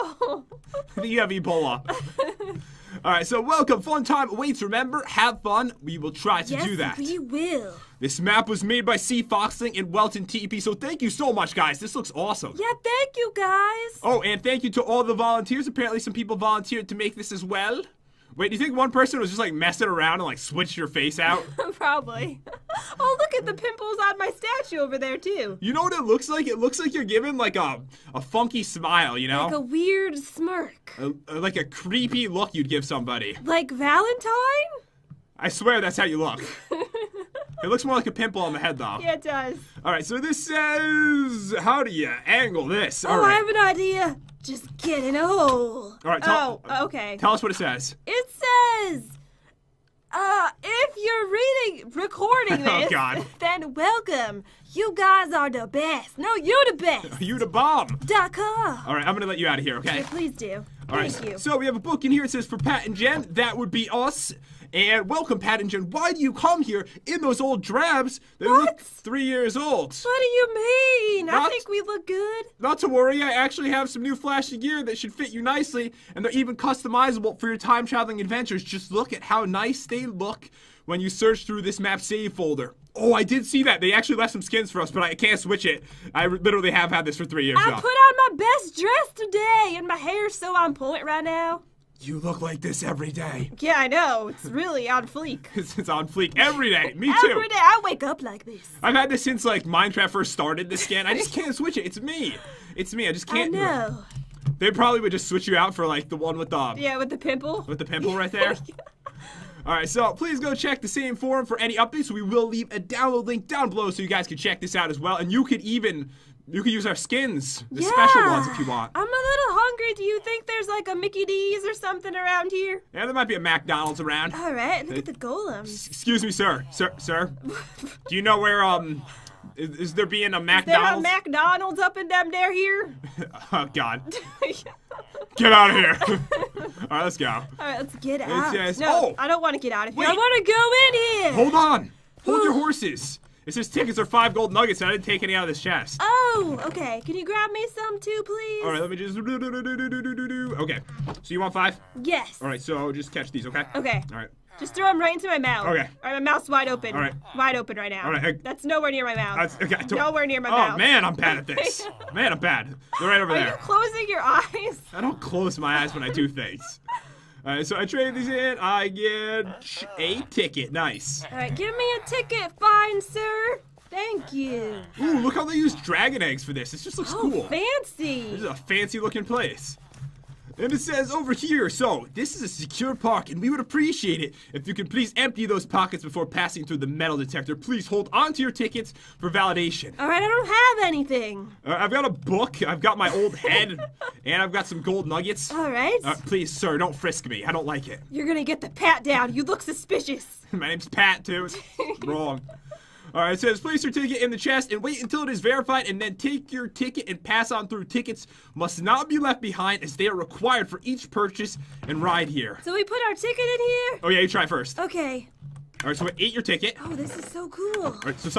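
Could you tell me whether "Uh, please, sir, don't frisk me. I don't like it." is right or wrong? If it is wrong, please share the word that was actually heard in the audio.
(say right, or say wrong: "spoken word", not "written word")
right.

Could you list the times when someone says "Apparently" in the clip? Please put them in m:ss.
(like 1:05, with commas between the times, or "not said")
0:15.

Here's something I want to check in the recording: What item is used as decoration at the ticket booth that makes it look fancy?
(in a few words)
dragon eggs.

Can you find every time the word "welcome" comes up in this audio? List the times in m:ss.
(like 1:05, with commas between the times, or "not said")
0:03, 0:53, 1:05.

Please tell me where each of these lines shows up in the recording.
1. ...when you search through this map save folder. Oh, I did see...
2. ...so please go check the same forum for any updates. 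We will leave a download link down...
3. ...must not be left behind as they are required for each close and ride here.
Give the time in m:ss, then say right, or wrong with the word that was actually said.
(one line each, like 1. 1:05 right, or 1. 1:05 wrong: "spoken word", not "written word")
1. 1:20 right
2. 1:49 right
3. 3:28 wrong: "purchase", not "close".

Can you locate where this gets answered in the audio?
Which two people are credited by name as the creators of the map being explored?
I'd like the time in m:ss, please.
0:08.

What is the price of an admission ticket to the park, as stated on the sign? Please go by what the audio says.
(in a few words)
5 gold nuggets.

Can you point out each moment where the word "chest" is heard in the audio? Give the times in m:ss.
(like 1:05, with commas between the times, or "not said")
2:25, 3:24.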